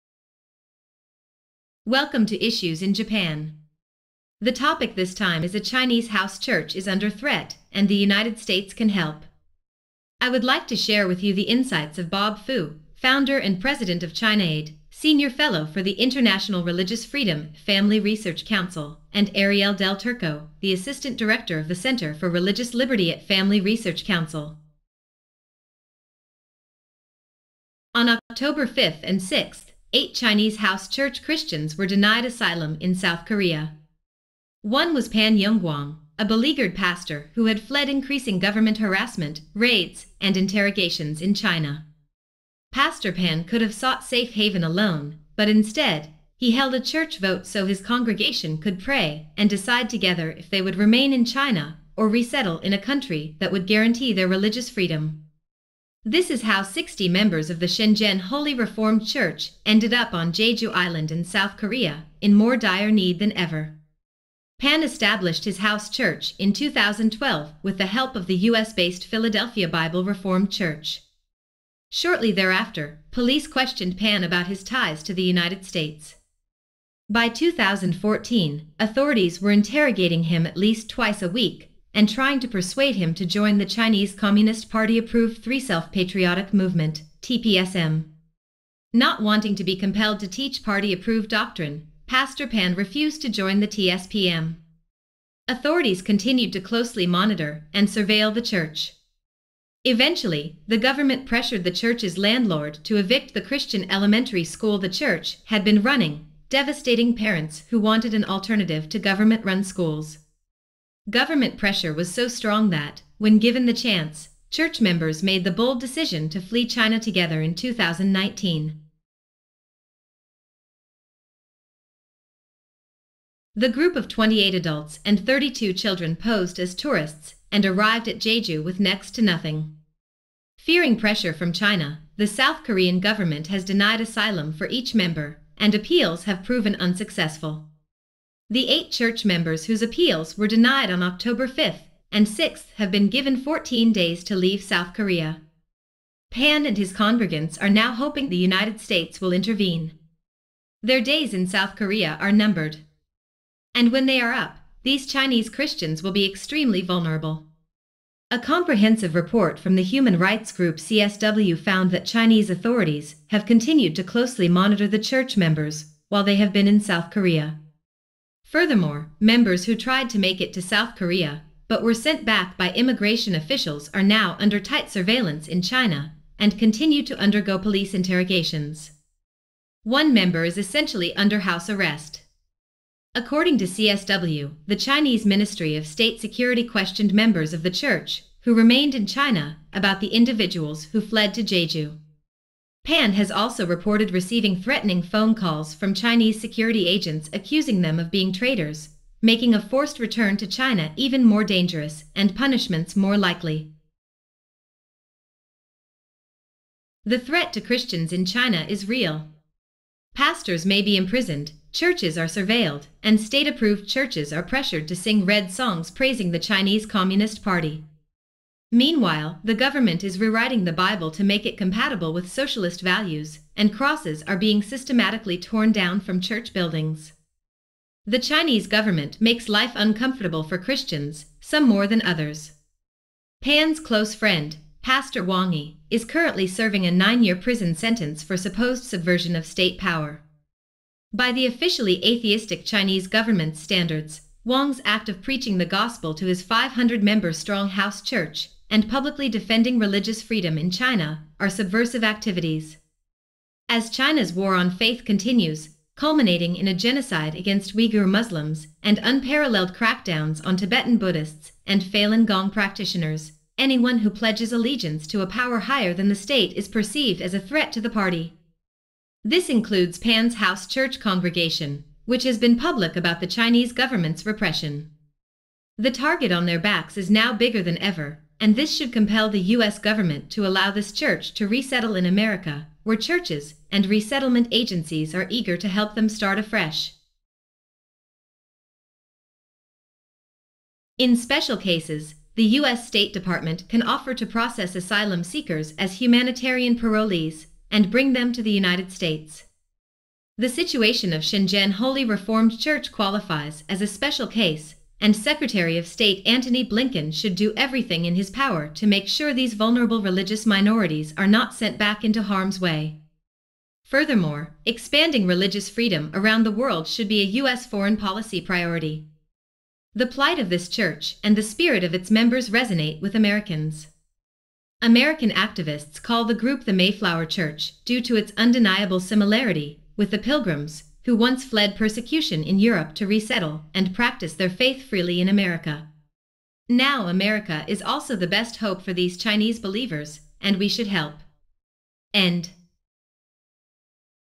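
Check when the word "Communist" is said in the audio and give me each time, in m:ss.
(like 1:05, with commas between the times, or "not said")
1:24, 3:36.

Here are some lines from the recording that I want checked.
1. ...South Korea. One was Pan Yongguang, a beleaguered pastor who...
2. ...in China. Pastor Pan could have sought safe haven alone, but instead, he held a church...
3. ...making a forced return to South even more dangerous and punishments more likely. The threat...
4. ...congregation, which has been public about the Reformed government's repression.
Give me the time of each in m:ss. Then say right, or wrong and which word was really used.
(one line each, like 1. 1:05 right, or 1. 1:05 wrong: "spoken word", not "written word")
1. 0:32 right
2. 0:41 right
3. 3:19 wrong: "China", not "South"
4. 4:30 wrong: "Chinese", not "Reformed".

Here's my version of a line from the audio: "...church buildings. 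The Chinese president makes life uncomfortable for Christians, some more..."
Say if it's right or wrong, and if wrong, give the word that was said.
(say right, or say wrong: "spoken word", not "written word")
wrong: "government", not "president".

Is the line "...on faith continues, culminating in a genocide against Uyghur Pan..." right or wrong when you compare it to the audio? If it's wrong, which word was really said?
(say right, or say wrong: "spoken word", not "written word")
wrong: "Muslims", not "Pan".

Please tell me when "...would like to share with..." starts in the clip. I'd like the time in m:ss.
0:10.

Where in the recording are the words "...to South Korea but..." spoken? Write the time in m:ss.
2:50.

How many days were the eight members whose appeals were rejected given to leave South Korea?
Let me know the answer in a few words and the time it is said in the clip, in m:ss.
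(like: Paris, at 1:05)
14, at 2:23.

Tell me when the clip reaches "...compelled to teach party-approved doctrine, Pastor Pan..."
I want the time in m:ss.
1:29.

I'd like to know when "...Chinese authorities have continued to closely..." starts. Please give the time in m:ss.
2:42.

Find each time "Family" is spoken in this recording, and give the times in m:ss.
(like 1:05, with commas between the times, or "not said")
0:17, 0:23.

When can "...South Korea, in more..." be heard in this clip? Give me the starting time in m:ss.
1:01.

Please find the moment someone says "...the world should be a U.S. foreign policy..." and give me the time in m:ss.
5:16.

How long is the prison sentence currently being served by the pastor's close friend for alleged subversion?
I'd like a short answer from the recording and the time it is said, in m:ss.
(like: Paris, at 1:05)
9 years, at 3:56.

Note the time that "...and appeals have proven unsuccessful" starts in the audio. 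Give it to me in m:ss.
2:15.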